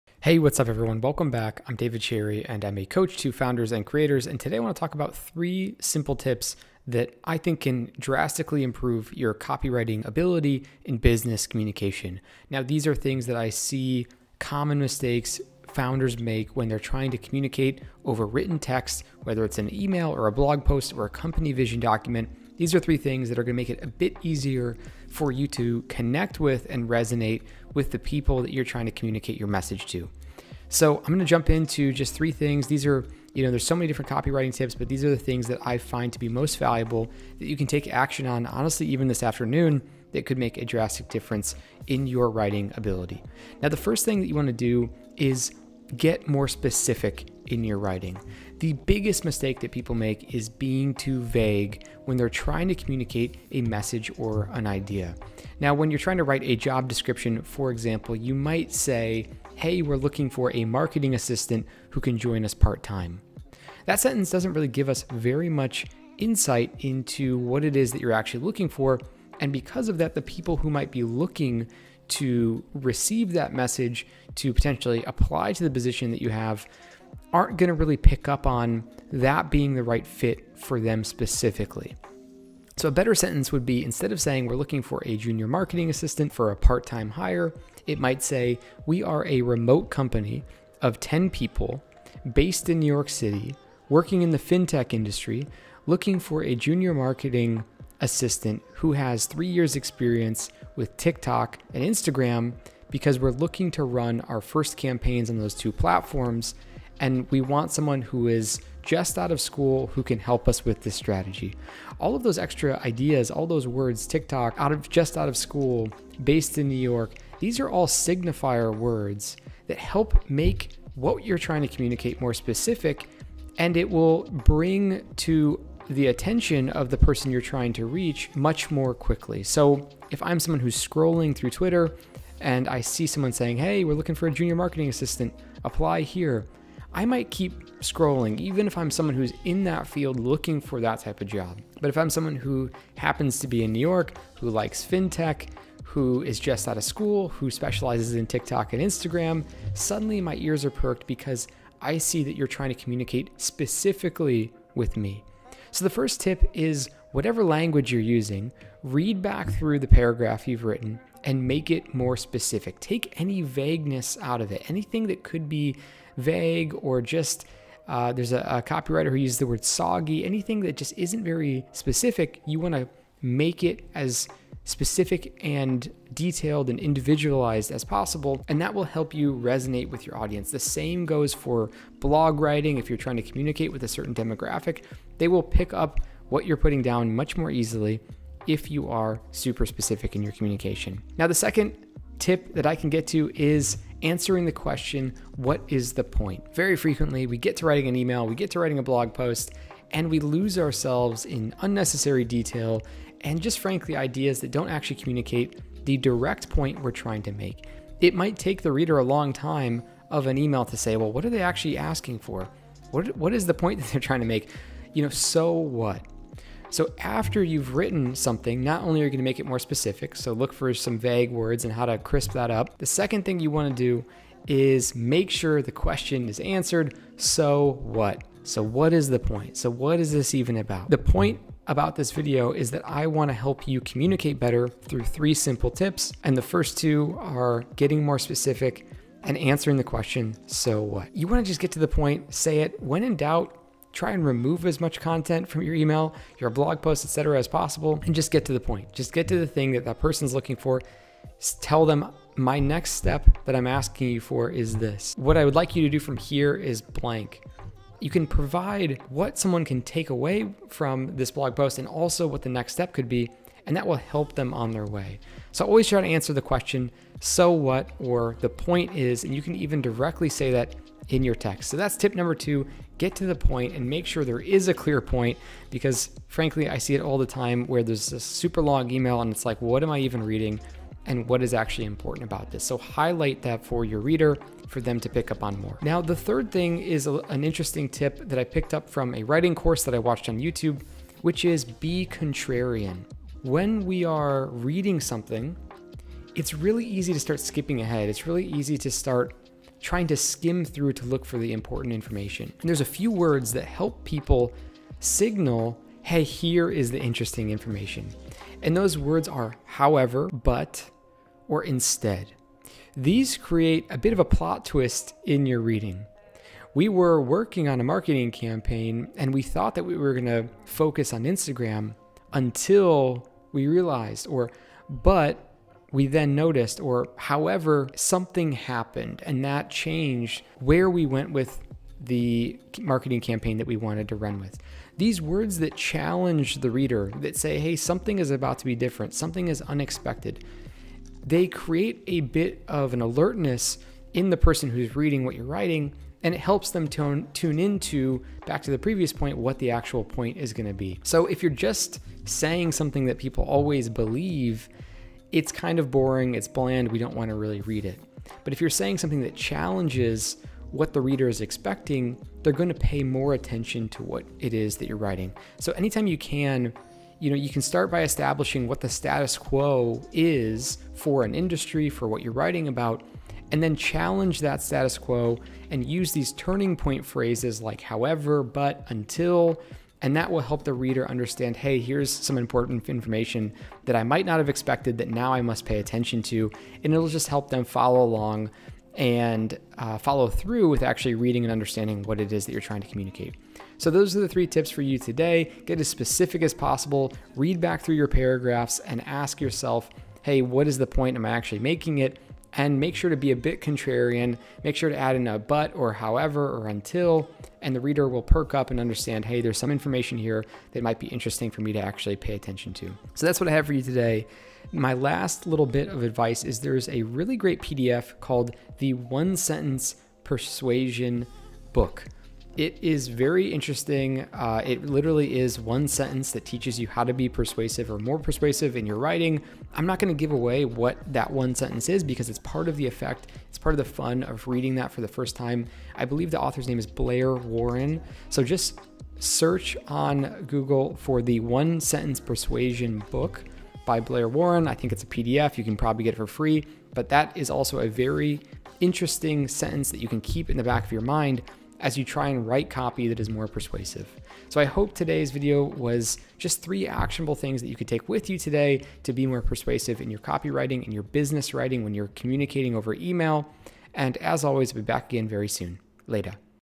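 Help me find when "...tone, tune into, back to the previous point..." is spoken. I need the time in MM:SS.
05:46.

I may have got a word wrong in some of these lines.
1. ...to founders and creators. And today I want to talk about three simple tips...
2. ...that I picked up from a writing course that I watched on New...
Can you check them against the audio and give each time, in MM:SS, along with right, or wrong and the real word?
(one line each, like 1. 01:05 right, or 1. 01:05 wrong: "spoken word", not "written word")
1. 00:03 right
2. 04:48 wrong: "YouTube", not "New".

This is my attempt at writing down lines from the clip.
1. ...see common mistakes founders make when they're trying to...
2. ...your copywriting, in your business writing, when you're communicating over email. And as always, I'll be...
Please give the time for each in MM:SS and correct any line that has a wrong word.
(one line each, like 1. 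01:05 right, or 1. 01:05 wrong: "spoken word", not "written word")
1. 00:13 right
2. 07:40 right.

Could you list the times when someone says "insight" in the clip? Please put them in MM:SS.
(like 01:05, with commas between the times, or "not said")
01:06.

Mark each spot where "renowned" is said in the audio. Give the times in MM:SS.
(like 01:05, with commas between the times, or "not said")
not said.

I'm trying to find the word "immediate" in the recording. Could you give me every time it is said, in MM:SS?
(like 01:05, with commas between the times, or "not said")
not said.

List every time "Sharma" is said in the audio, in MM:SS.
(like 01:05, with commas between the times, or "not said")
not said.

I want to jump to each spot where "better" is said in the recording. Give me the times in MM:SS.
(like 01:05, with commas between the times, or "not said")
01:22, 03:54.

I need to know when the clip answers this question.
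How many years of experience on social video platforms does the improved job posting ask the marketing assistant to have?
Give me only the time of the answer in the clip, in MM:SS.
01:39.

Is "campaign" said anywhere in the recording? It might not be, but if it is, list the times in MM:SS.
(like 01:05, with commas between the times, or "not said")
01:44, 05:18, 05:33.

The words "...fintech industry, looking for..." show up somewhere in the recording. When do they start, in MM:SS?
01:34.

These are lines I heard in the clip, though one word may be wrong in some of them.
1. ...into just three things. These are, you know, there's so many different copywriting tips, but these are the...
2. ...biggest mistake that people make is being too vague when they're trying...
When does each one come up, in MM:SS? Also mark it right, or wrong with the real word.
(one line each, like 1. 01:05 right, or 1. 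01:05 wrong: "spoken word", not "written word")
1. 00:31 right
2. 00:48 right.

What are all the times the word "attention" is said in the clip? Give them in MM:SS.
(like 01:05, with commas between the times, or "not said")
02:06, 06:03, 06:25, 06:52.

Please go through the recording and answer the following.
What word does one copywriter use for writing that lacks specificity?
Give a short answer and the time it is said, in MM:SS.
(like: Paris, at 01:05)
Soggy, at 02:49.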